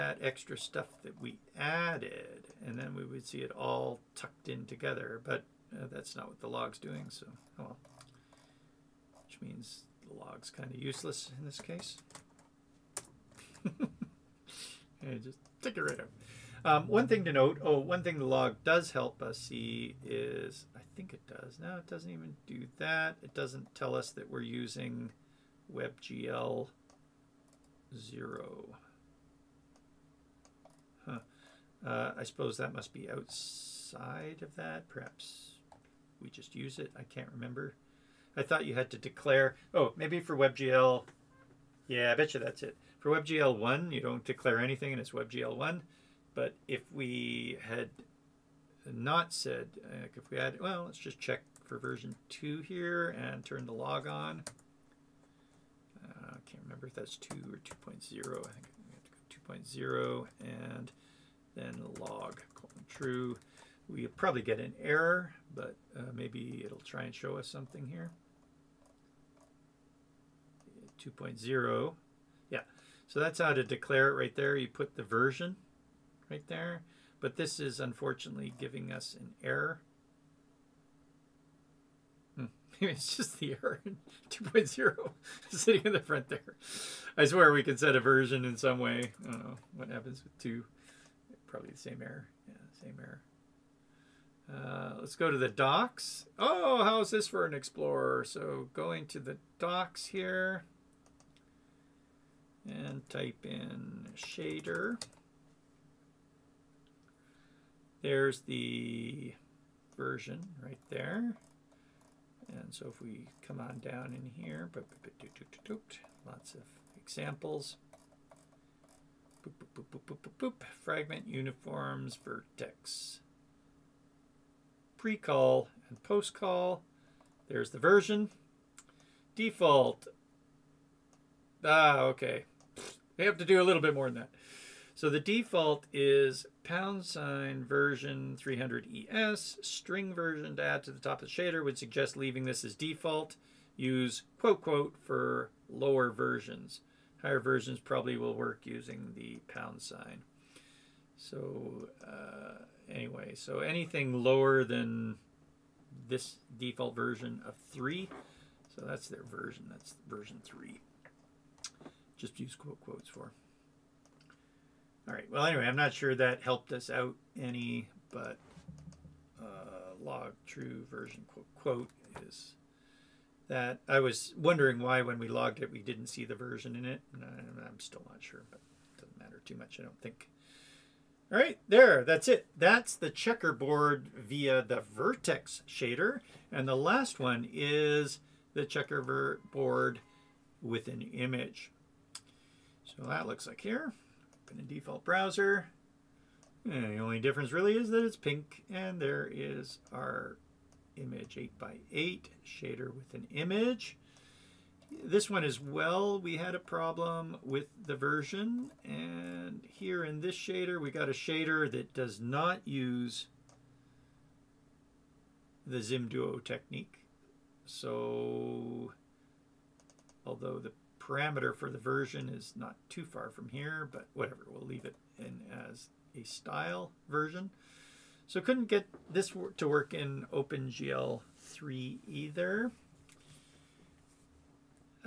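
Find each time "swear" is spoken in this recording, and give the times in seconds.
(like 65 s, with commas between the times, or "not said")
87 s.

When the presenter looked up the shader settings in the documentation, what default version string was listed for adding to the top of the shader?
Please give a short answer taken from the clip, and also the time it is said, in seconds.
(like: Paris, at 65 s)
#version 300 es, at 136 s.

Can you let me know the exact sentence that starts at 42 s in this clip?
For WebGL 1, you don't declare anything and it's WebGL 1.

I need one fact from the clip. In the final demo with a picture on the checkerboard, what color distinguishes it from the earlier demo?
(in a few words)
Pink.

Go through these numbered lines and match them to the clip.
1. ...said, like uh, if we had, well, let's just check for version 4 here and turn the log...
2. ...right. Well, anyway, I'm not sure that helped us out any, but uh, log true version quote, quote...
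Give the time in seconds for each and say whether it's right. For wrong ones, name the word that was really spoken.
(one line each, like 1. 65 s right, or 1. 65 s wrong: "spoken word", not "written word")
1. 49 s wrong: "2", not "4"
2. 165 s right.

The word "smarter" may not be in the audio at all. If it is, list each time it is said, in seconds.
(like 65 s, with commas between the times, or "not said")
not said.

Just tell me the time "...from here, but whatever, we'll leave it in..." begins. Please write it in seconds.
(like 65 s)
223 s.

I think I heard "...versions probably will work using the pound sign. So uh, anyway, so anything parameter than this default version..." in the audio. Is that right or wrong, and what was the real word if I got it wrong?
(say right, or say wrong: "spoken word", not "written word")
wrong: "lower", not "parameter".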